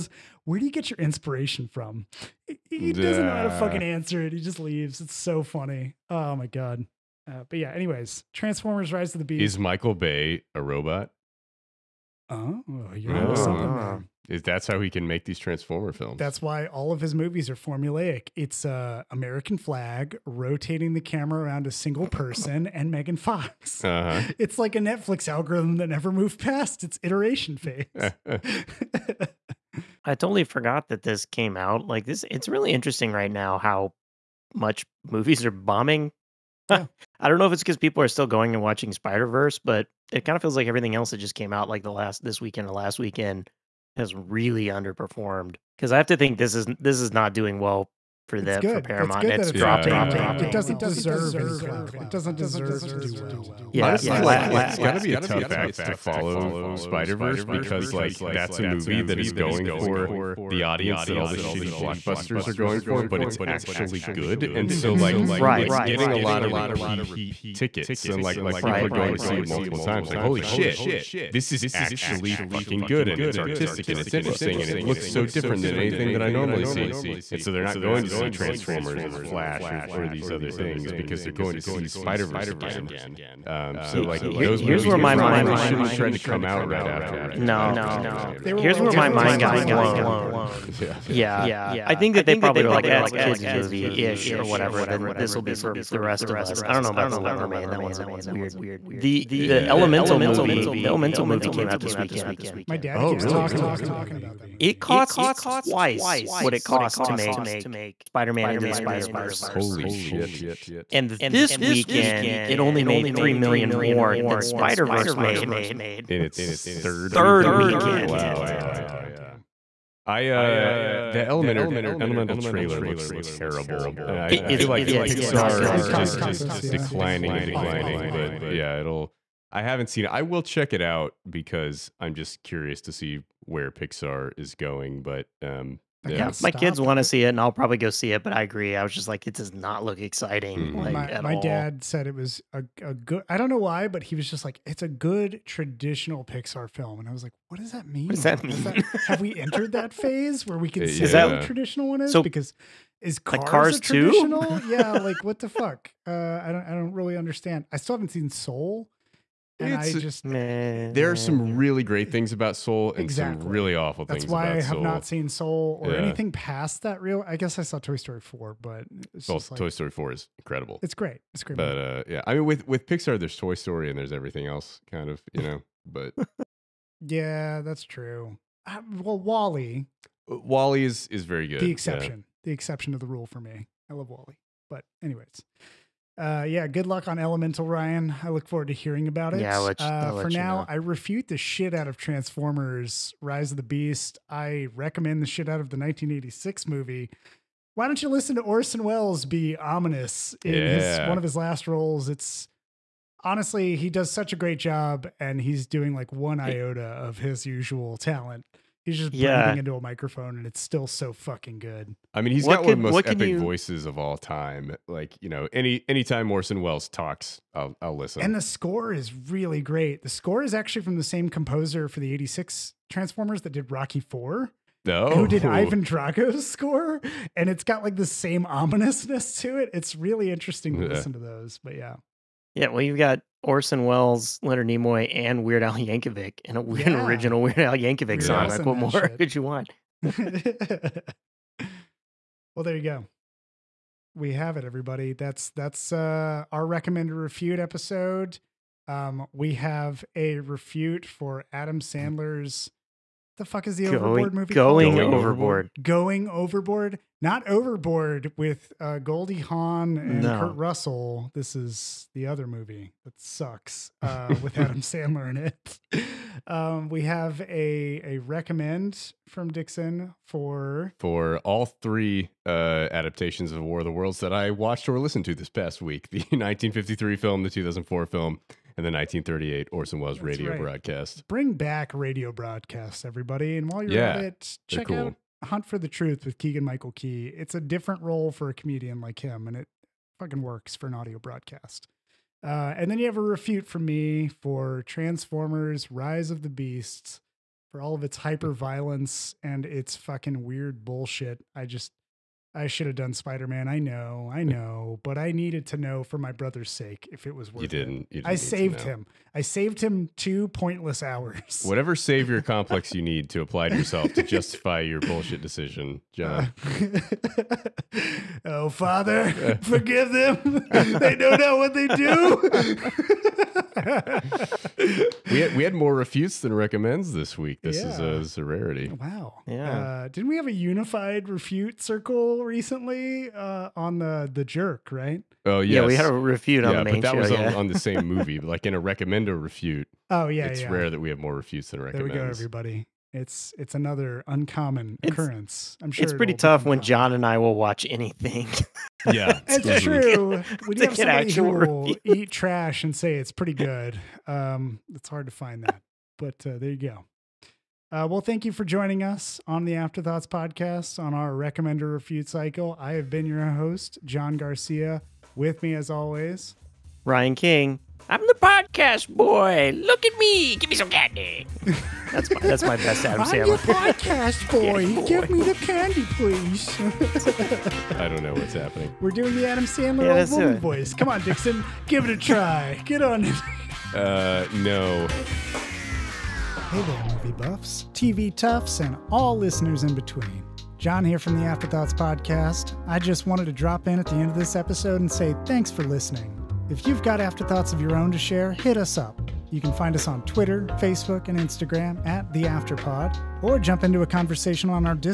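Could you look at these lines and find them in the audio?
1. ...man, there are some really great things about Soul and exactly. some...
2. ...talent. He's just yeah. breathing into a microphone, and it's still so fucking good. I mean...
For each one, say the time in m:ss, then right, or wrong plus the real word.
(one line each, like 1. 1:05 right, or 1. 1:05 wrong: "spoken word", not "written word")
1. 2:40 right
2. 3:27 right.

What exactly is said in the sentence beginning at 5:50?
We have somebody who will eat trash and say it's pretty good, um, it's hard to find that.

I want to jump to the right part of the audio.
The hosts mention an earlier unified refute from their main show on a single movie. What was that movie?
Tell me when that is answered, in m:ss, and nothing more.
5:34.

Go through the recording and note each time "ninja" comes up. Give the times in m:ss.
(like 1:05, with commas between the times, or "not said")
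not said.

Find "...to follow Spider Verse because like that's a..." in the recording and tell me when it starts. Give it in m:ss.
0:55.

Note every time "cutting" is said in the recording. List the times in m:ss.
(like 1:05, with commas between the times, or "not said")
not said.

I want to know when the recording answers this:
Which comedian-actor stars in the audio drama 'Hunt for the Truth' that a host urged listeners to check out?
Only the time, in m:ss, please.
4:46.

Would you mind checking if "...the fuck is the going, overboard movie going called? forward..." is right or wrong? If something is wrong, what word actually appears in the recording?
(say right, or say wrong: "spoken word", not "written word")
wrong: "overboard", not "forward".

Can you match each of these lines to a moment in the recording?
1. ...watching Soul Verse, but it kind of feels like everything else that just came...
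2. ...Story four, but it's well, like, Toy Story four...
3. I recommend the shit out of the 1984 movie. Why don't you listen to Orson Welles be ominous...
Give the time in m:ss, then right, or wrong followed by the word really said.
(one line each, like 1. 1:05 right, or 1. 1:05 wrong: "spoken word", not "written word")
1. 0:38 wrong: "Spider", not "Soul"
2. 2:47 right
3. 3:14 wrong: "1986", not "1984".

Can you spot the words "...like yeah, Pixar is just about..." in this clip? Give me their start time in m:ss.
2:04.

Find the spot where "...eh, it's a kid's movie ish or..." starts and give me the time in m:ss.
1:32.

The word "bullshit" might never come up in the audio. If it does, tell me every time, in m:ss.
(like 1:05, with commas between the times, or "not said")
5:00, 5:15.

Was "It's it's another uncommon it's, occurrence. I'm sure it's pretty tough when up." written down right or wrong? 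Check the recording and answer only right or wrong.
right.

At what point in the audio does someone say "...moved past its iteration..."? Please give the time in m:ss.
0:26.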